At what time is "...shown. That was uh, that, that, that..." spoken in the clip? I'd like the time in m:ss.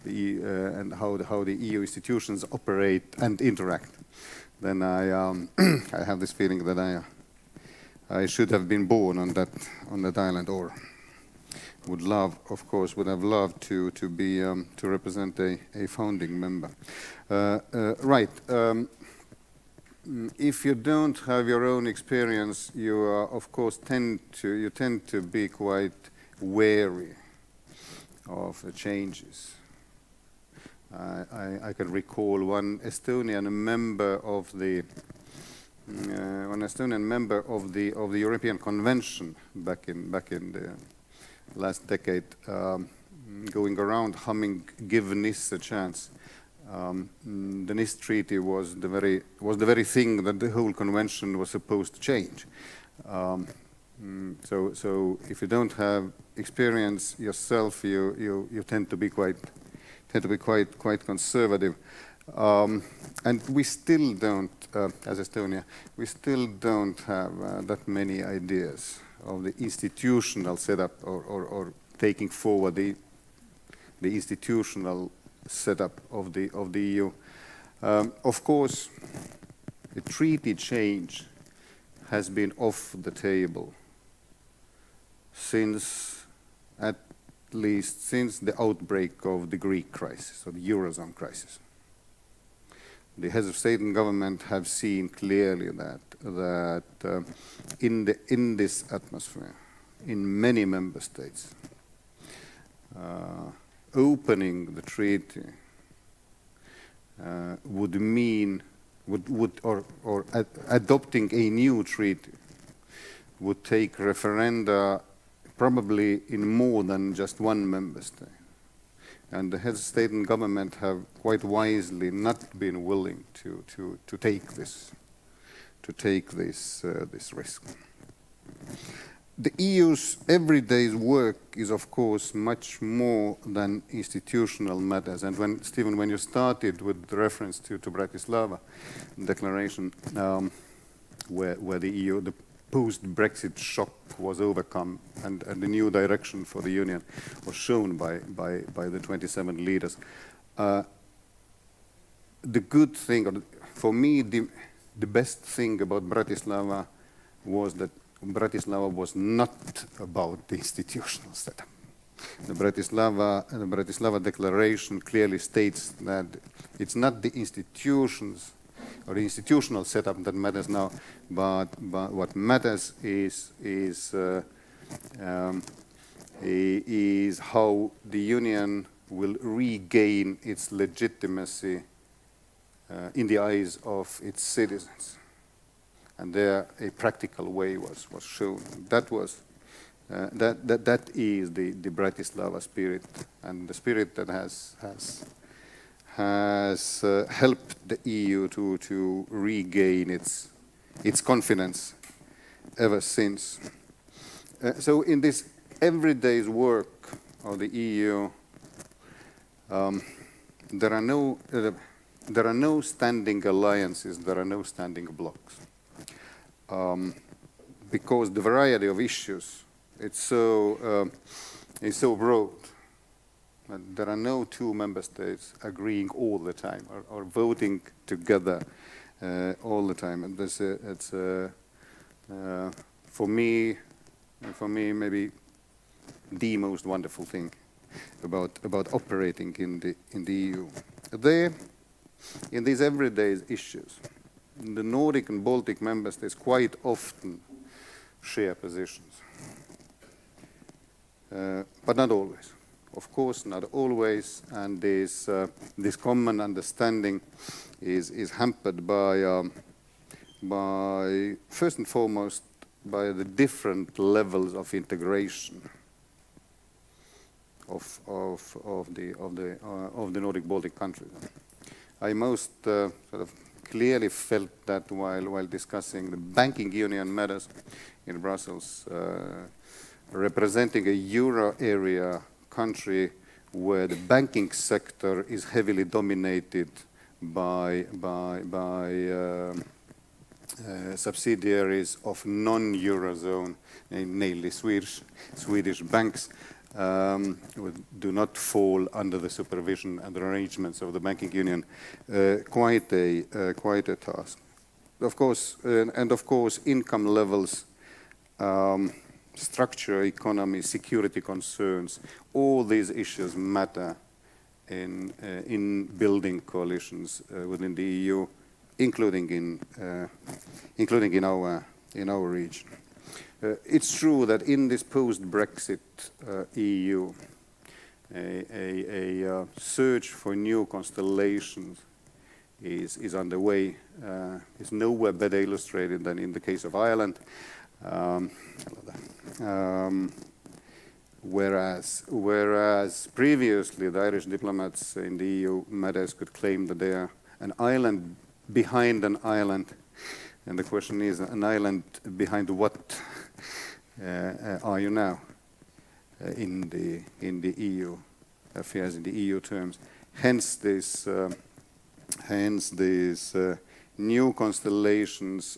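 3:08.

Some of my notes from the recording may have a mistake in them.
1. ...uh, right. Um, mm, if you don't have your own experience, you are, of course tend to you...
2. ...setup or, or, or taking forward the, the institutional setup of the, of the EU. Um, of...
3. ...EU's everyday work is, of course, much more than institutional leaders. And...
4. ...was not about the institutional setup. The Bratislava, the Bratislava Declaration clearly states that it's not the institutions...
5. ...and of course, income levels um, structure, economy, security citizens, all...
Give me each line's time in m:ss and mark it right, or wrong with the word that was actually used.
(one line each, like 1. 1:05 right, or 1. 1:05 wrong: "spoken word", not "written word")
1. 0:17 right
2. 1:10 right
3. 2:09 wrong: "matters", not "leaders"
4. 2:38 right
5. 5:06 wrong: "concerns", not "citizens".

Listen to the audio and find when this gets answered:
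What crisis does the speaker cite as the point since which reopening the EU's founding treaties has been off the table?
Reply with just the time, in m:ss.
1:29.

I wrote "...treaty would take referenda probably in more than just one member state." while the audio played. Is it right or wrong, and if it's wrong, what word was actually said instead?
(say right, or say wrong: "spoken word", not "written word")
right.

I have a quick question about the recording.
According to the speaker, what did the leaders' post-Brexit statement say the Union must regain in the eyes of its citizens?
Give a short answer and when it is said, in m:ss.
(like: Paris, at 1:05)
legitimacy, at 3:00.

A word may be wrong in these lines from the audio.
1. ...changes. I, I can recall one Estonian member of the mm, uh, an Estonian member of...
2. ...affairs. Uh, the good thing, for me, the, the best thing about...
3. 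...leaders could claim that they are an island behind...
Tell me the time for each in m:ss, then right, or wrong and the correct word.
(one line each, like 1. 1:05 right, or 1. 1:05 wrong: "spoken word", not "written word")
1. 0:28 right
2. 2:29 wrong: "leaders", not "affairs"
3. 5:45 wrong: "matters", not "leaders".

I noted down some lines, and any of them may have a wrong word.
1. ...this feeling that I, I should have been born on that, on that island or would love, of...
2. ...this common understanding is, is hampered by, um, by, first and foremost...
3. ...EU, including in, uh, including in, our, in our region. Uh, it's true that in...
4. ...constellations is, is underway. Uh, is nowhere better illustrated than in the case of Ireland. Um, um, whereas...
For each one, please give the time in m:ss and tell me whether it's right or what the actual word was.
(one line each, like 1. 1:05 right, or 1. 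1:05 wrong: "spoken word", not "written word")
1. 0:06 right
2. 4:15 right
3. 5:17 right
4. 5:30 right.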